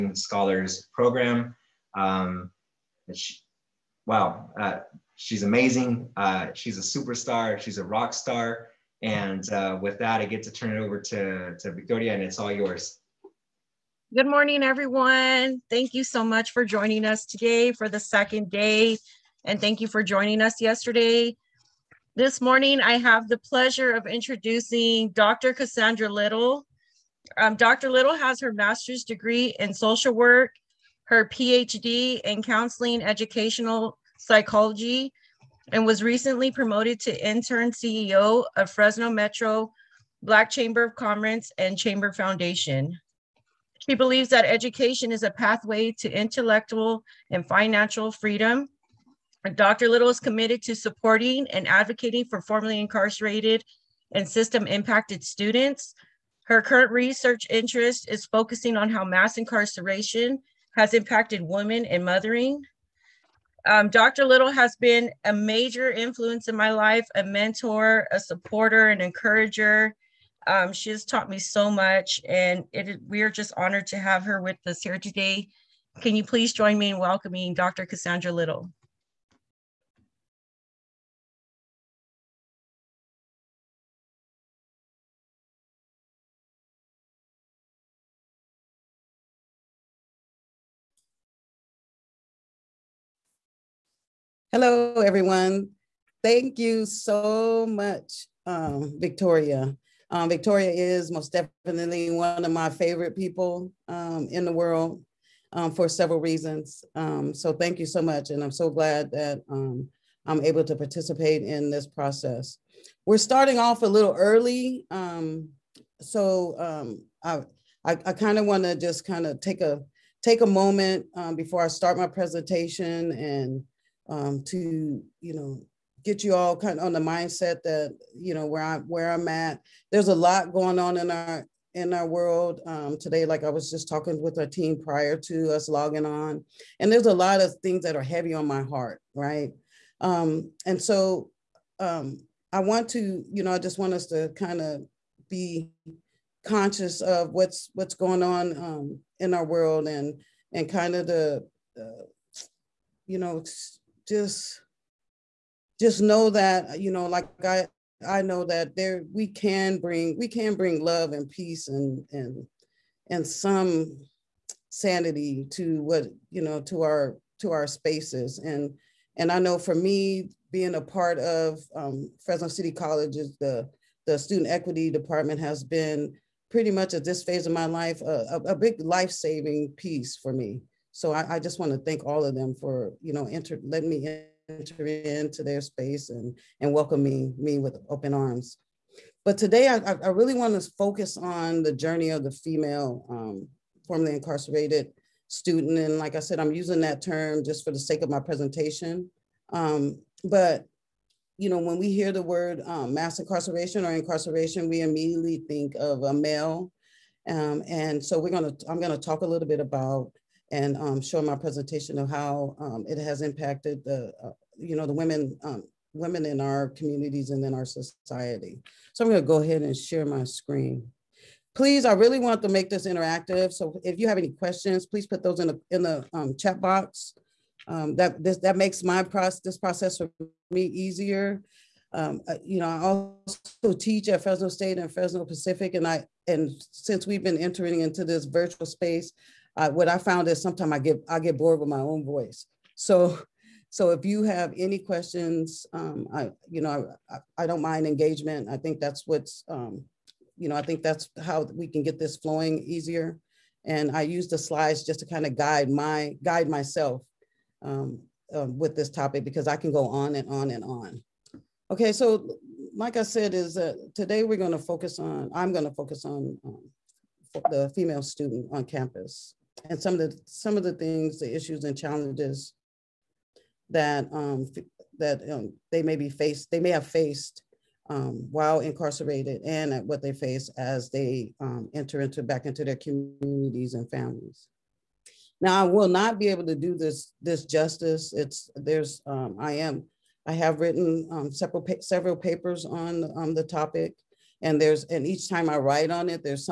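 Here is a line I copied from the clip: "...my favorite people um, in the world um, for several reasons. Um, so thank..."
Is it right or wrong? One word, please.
right.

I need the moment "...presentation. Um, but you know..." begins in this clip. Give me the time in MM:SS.
03:18.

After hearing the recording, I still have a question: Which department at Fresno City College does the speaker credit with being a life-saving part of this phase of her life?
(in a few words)
Student equity department.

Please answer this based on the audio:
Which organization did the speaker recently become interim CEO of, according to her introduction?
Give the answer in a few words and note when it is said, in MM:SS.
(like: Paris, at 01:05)
Fresno Metro Black Chamber of Commerce, at 00:38.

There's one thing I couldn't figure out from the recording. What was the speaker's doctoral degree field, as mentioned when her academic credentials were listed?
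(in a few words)
Counseling educational psychology.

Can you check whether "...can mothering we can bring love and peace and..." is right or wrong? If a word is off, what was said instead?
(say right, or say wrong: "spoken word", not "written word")
wrong: "bring", not "mothering".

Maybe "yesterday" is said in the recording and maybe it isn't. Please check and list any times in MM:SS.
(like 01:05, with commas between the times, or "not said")
00:20.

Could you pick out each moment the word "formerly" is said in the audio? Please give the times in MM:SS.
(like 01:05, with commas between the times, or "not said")
00:52, 03:13.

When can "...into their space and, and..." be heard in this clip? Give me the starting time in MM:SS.
03:04.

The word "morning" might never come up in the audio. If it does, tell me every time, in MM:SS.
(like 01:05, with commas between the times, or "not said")
00:14, 00:22.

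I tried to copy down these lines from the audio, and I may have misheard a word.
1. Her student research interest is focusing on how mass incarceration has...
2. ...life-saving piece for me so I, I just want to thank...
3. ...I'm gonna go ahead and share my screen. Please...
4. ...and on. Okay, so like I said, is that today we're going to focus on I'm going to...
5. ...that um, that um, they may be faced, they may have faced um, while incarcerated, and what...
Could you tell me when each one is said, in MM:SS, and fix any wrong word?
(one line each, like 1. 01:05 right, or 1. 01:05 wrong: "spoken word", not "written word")
1. 00:56 wrong: "current", not "student"
2. 02:58 right
3. 03:39 right
4. 04:20 right
5. 04:33 right.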